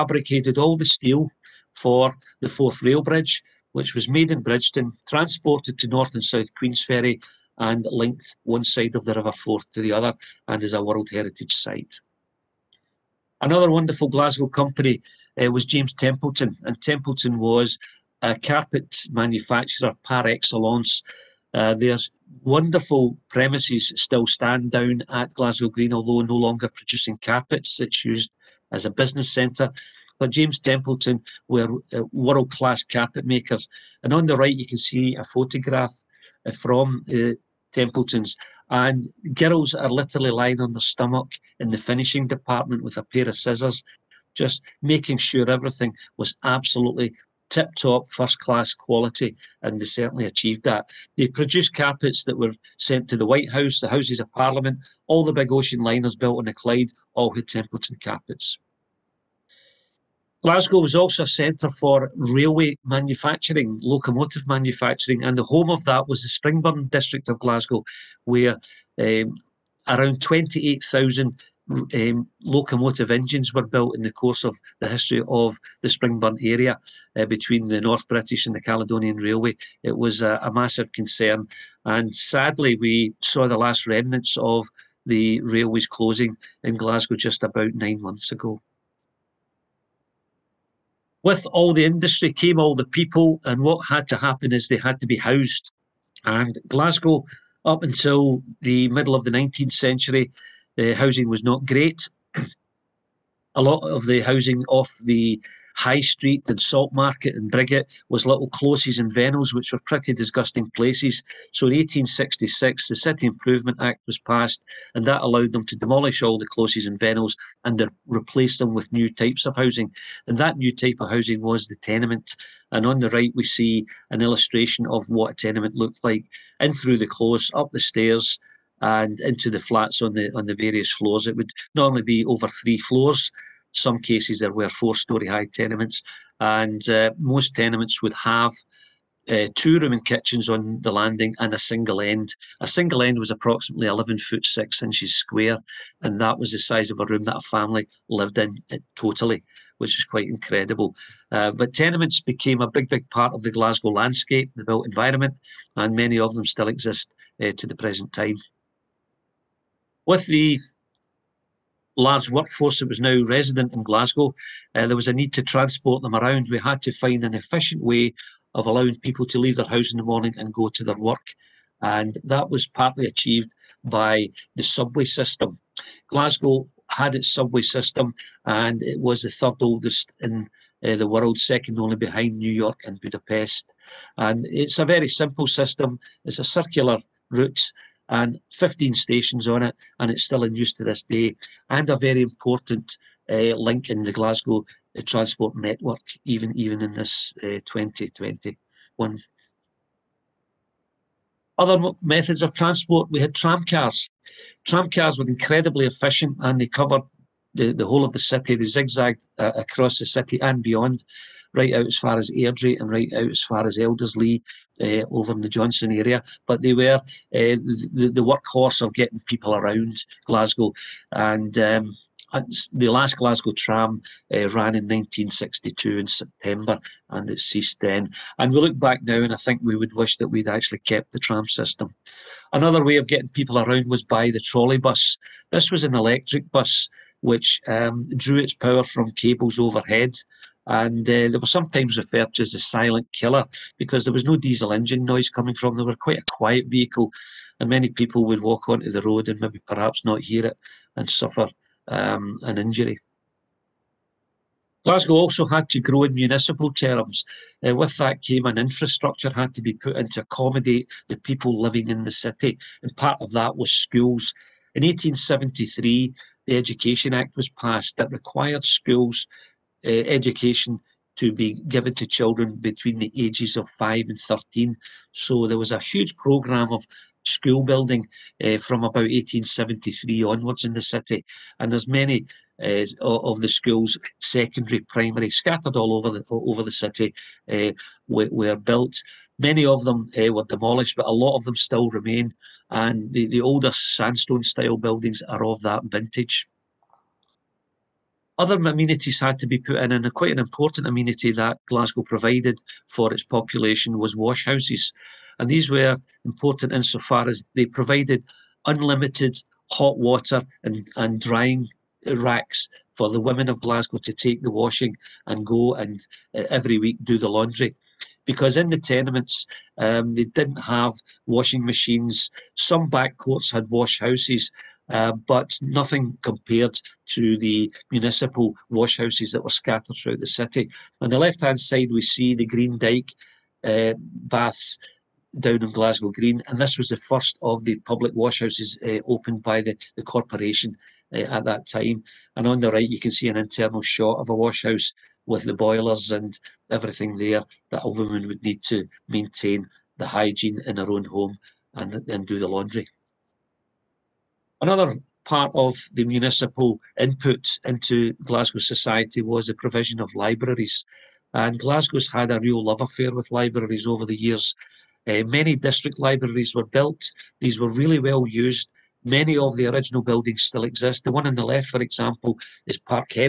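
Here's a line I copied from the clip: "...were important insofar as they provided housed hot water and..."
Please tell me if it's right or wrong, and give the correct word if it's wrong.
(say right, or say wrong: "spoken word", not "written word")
wrong: "unlimited", not "housed".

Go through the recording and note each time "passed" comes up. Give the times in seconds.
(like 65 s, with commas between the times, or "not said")
114 s, 267 s.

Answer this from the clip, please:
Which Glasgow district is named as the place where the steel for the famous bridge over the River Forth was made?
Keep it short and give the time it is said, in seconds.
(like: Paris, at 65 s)
Bridgeton, at 4 s.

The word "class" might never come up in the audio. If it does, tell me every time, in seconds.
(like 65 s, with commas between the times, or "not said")
32 s, 48 s.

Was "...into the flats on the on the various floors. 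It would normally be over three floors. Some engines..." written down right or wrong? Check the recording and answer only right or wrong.
wrong.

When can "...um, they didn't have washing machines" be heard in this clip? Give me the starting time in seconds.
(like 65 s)
319 s.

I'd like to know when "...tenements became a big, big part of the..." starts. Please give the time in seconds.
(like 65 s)
151 s.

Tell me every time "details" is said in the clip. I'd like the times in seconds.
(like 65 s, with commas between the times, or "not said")
not said.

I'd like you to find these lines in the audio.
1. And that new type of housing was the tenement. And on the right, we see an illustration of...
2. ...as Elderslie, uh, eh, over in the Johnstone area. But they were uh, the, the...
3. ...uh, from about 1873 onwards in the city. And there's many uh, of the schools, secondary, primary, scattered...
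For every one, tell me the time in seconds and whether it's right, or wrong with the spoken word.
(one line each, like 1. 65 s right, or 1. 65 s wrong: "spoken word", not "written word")
1. 120 s right
2. 213 s right
3. 278 s right.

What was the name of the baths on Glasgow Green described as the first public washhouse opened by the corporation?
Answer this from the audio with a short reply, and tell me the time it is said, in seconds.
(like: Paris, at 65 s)
Green Dyke, at 332 s.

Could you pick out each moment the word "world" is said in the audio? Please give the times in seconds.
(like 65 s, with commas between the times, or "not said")
10 s, 32 s, 181 s.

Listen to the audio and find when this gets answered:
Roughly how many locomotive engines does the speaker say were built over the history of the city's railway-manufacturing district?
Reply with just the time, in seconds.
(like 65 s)
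70 s.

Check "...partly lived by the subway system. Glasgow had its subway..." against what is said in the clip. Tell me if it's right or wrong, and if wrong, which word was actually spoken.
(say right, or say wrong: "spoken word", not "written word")
wrong: "achieved", not "lived".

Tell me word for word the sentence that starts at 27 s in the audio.
It's used as a business centre.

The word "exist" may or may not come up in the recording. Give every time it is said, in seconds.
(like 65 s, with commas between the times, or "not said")
156 s, 370 s.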